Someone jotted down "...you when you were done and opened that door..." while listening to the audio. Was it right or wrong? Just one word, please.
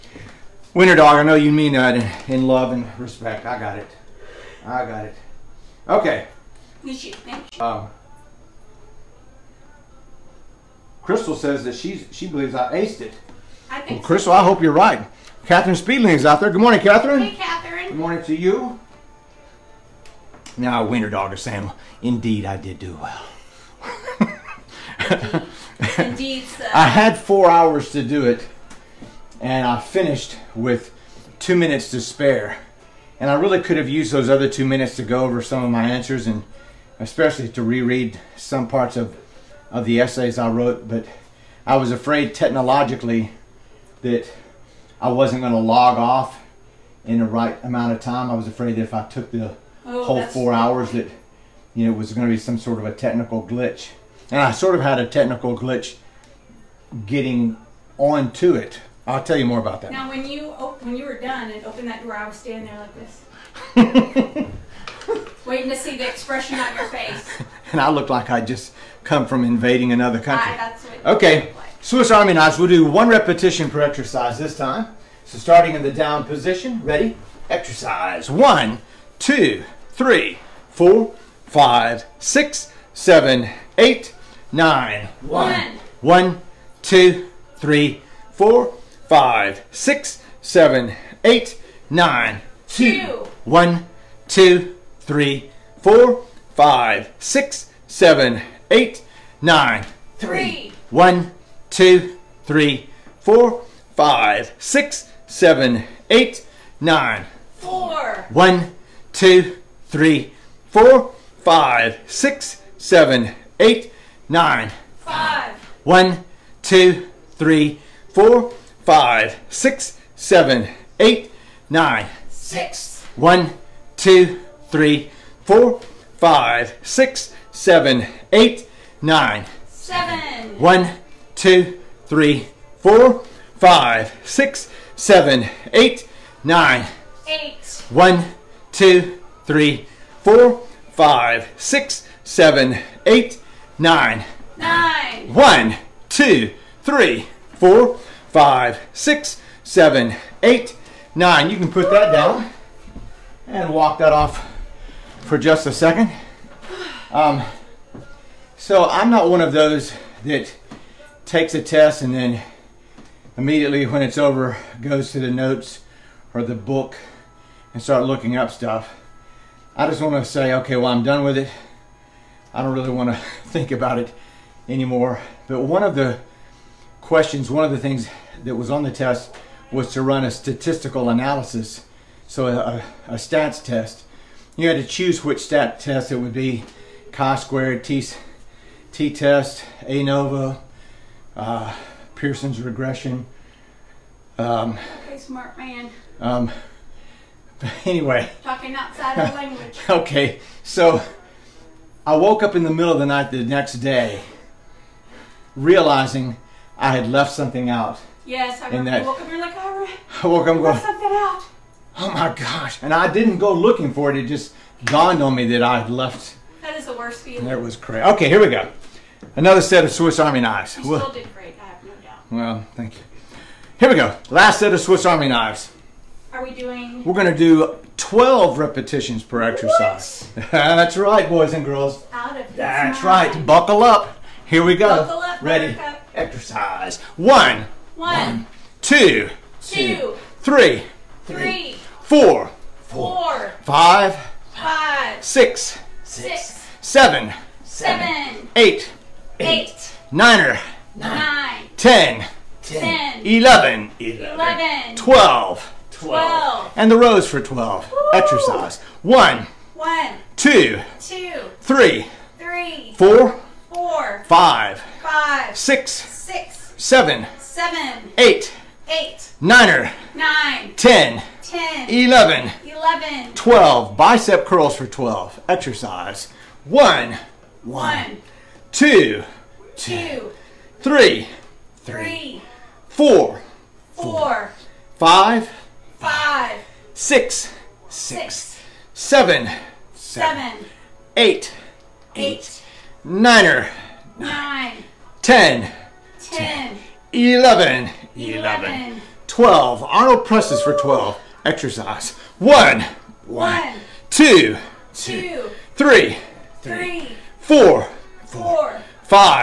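right.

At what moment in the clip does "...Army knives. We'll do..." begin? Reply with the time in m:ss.
1:12.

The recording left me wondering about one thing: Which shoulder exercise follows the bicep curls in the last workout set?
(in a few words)
Arnold presses.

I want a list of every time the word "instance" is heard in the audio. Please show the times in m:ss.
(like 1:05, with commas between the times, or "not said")
not said.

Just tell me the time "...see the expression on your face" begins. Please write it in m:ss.
1:05.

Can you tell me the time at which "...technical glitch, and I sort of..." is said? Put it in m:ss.
0:52.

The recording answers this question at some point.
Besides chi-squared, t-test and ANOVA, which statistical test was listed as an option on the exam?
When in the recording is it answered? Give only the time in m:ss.
3:12.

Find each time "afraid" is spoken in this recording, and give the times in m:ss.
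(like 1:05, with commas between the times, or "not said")
0:41, 0:48.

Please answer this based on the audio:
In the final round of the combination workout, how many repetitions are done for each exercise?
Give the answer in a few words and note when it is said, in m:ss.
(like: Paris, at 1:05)
12, at 3:47.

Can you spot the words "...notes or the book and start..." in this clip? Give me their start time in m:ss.
2:45.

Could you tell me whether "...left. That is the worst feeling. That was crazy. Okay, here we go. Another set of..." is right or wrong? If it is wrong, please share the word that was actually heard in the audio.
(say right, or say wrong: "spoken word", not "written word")
right.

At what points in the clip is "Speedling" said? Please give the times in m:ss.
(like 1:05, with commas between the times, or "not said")
0:15.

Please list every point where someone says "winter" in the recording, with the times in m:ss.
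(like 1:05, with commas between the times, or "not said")
0:00, 0:20.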